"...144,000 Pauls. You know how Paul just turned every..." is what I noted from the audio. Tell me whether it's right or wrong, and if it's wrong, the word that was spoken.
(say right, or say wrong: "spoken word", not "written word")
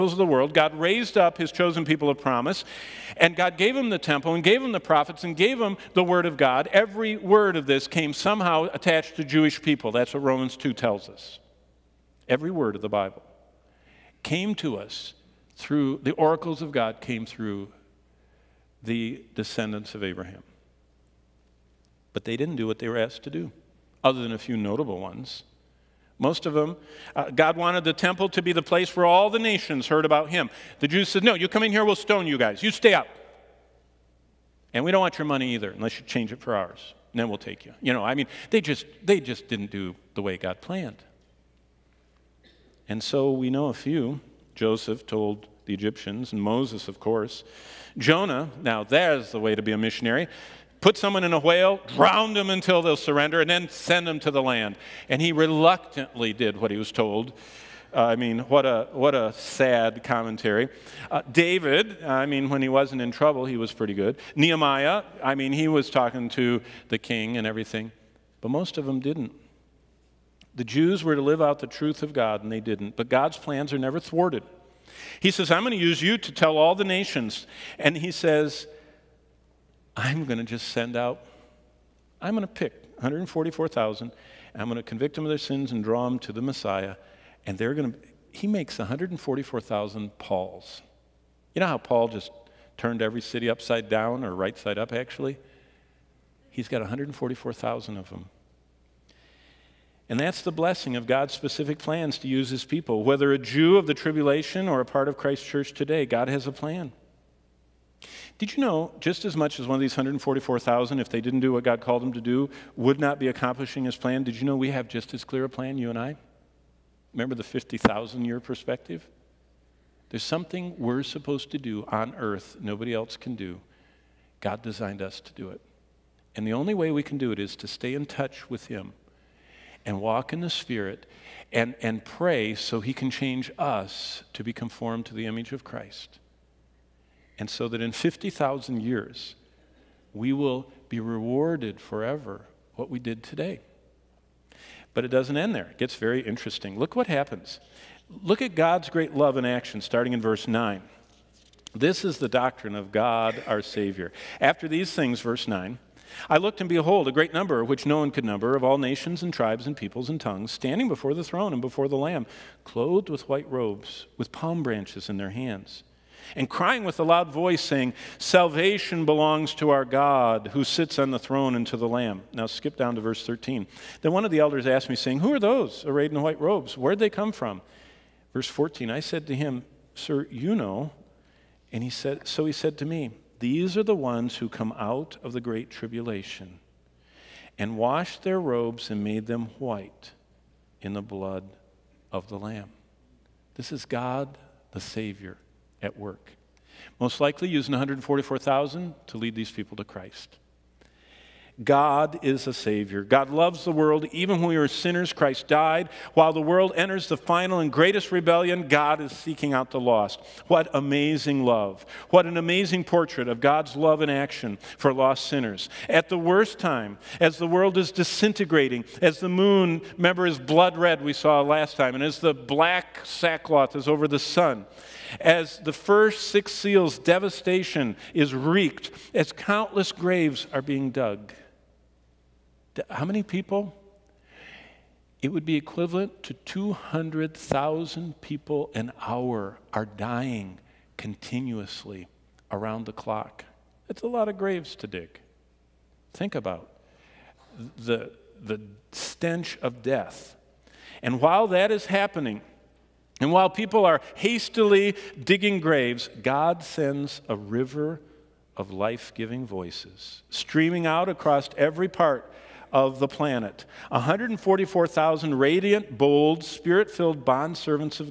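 right.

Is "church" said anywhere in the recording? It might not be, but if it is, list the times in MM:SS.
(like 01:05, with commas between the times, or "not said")
01:45.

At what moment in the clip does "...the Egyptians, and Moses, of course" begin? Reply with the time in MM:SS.
00:45.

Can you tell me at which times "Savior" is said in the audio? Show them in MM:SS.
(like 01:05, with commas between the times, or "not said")
02:33, 03:14, 03:22.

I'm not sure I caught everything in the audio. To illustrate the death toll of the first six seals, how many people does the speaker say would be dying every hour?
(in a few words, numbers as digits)
200,000.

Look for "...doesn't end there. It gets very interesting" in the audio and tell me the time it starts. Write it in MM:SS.
02:25.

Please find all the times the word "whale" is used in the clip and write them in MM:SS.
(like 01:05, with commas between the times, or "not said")
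00:51.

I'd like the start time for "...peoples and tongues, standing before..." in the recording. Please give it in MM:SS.
02:39.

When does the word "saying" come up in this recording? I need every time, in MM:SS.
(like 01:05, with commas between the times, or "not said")
02:47, 02:54.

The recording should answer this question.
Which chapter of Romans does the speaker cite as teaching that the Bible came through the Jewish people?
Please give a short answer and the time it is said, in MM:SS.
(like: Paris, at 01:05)
Romans 2, at 00:10.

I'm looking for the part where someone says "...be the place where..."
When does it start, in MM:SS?
00:28.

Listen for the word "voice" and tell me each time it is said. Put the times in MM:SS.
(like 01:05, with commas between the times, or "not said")
02:47, 04:19.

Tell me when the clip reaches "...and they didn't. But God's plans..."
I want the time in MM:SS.
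01:12.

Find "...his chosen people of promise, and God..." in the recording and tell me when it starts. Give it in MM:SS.
00:01.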